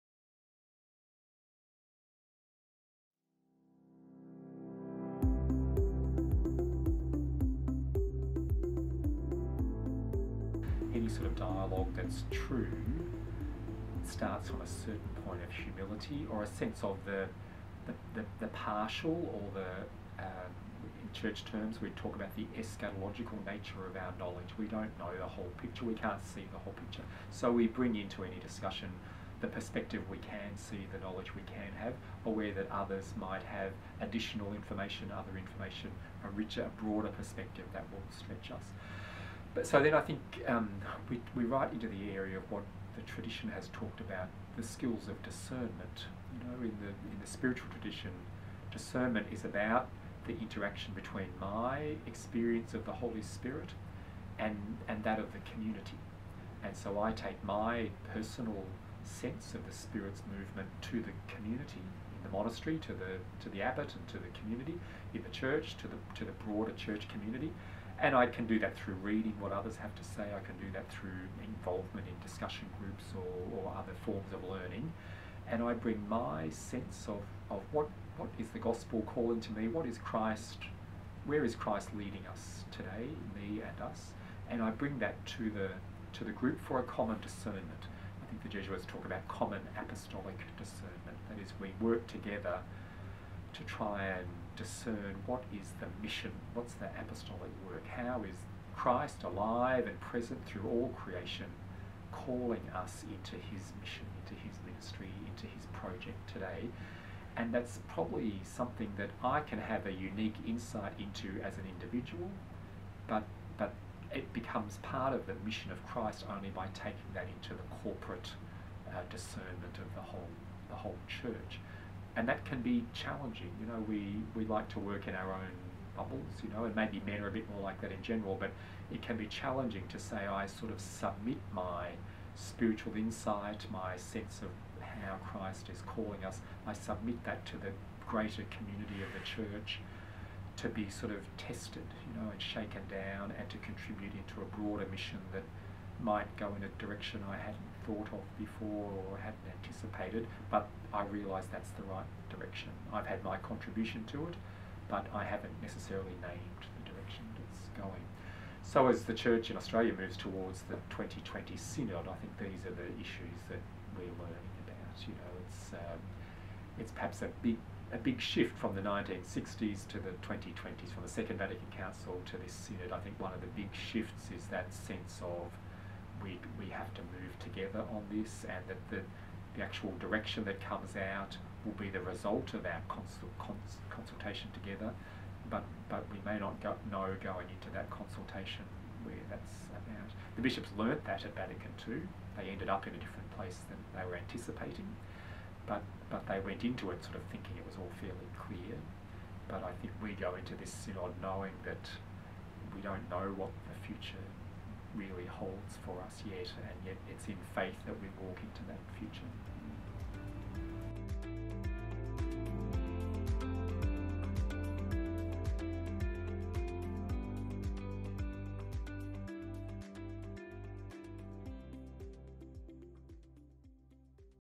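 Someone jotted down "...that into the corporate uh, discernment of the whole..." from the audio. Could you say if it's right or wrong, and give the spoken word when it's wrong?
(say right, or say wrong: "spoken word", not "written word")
right.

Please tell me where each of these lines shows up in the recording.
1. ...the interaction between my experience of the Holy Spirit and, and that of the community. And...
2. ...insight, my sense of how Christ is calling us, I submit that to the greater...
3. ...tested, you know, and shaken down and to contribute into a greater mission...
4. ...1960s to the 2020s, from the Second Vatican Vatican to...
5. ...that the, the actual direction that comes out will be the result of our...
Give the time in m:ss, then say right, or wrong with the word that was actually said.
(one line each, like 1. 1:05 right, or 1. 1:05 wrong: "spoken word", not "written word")
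1. 0:50 right
2. 2:12 right
3. 2:21 wrong: "broader", not "greater"
4. 2:48 wrong: "Council", not "Vatican"
5. 2:58 right.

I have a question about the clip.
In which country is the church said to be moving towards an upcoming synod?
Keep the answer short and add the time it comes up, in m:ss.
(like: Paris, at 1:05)
Australia, at 2:39.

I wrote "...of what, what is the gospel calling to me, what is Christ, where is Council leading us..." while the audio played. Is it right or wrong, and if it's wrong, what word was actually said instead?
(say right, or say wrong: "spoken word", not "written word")
wrong: "Christ", not "Council".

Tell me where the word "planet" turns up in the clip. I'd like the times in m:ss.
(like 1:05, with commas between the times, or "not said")
not said.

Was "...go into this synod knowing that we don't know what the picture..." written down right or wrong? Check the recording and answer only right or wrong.
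wrong.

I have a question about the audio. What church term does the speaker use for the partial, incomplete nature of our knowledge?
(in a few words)
eschatological.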